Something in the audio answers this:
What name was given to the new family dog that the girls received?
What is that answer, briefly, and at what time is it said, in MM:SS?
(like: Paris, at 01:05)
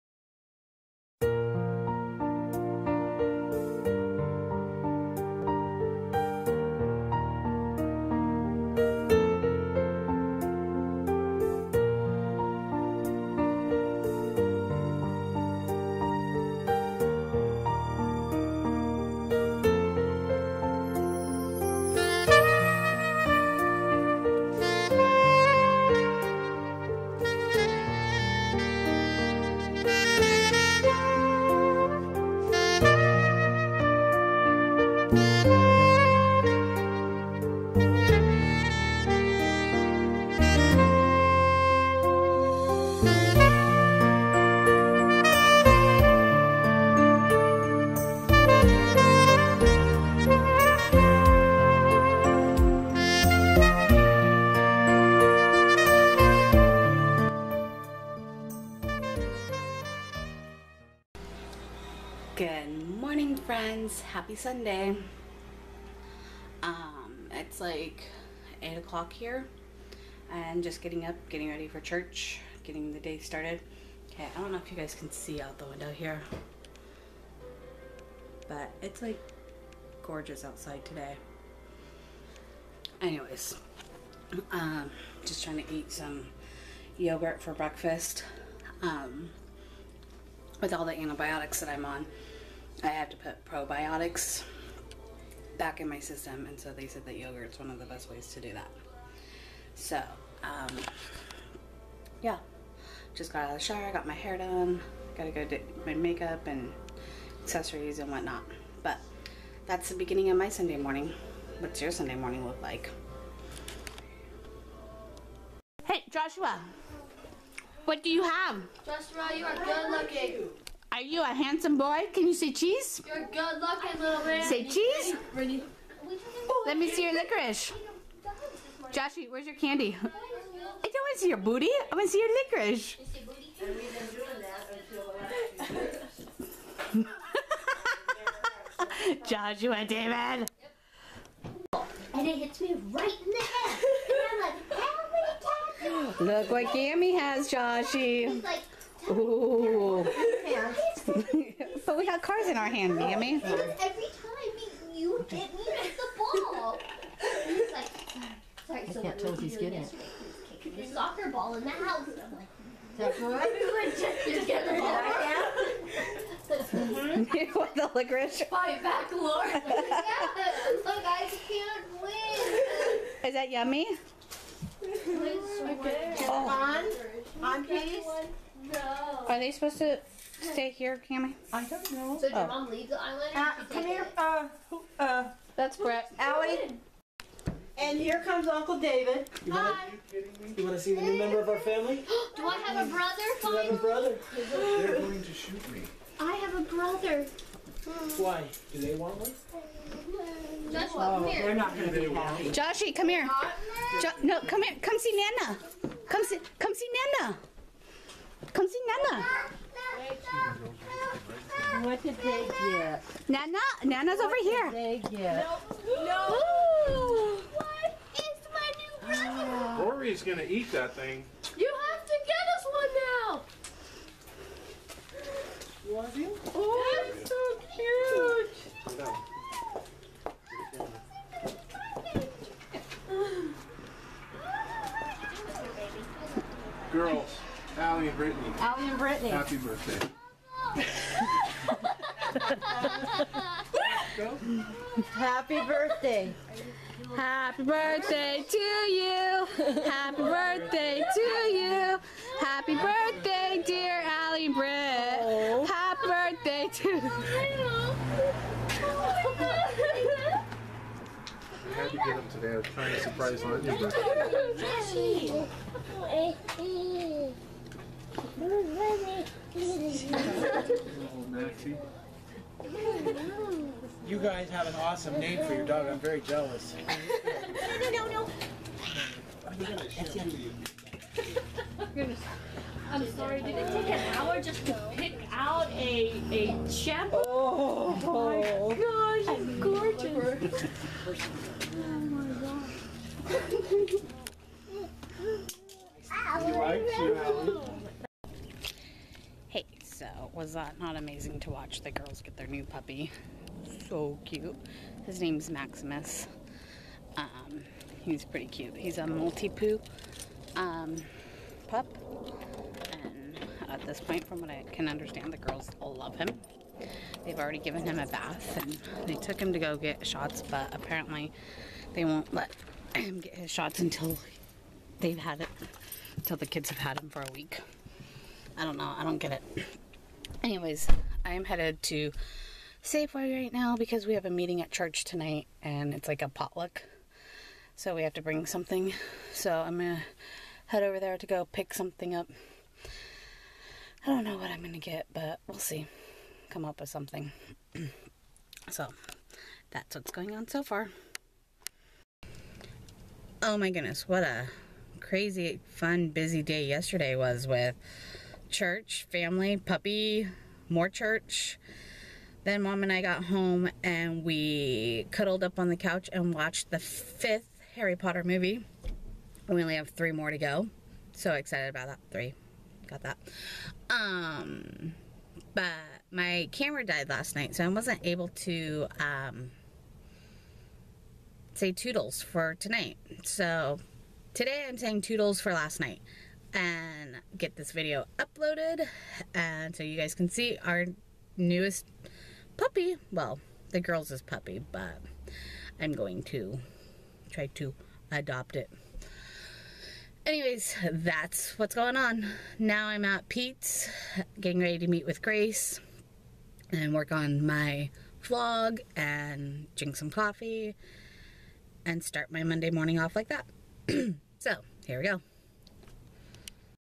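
Maximus, at 05:05.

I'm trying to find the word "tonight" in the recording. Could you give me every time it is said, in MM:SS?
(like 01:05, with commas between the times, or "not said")
05:35, 06:22.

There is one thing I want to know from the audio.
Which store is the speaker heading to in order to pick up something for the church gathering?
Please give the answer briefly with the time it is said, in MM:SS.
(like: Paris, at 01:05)
Safeway, at 05:32.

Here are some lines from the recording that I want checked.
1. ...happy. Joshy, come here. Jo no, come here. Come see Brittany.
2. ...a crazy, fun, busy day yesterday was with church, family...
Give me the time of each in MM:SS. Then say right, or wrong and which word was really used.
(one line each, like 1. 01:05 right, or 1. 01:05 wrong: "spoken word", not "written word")
1. 03:22 wrong: "Nana", not "Brittany"
2. 05:54 right.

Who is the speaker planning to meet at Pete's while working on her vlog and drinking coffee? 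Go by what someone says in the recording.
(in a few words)
Grace.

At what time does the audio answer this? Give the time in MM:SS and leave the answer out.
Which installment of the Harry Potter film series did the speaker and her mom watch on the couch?
06:06.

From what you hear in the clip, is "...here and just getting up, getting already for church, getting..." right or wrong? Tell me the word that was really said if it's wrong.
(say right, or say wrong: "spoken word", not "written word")
wrong: "ready", not "already".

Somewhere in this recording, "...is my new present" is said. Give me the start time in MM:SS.
03:38.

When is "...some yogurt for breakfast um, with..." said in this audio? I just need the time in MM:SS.
01:25.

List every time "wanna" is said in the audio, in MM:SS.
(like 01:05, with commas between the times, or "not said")
03:09.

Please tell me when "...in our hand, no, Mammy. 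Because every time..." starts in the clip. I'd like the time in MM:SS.
02:32.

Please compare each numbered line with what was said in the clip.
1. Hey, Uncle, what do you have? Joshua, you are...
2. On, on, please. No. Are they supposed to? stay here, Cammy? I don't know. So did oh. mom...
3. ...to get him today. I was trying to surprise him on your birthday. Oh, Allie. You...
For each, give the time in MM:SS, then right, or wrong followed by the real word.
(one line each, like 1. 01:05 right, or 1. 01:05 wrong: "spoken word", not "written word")
1. 01:55 wrong: "Joshua", not "Uncle"
2. 02:57 right
3. 04:21 wrong: "Maxie", not "Allie".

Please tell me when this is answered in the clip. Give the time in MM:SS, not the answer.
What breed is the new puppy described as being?
05:09.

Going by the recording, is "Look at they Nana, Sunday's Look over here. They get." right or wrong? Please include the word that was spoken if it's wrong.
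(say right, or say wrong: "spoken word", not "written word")
wrong: "Nana", not "Sunday".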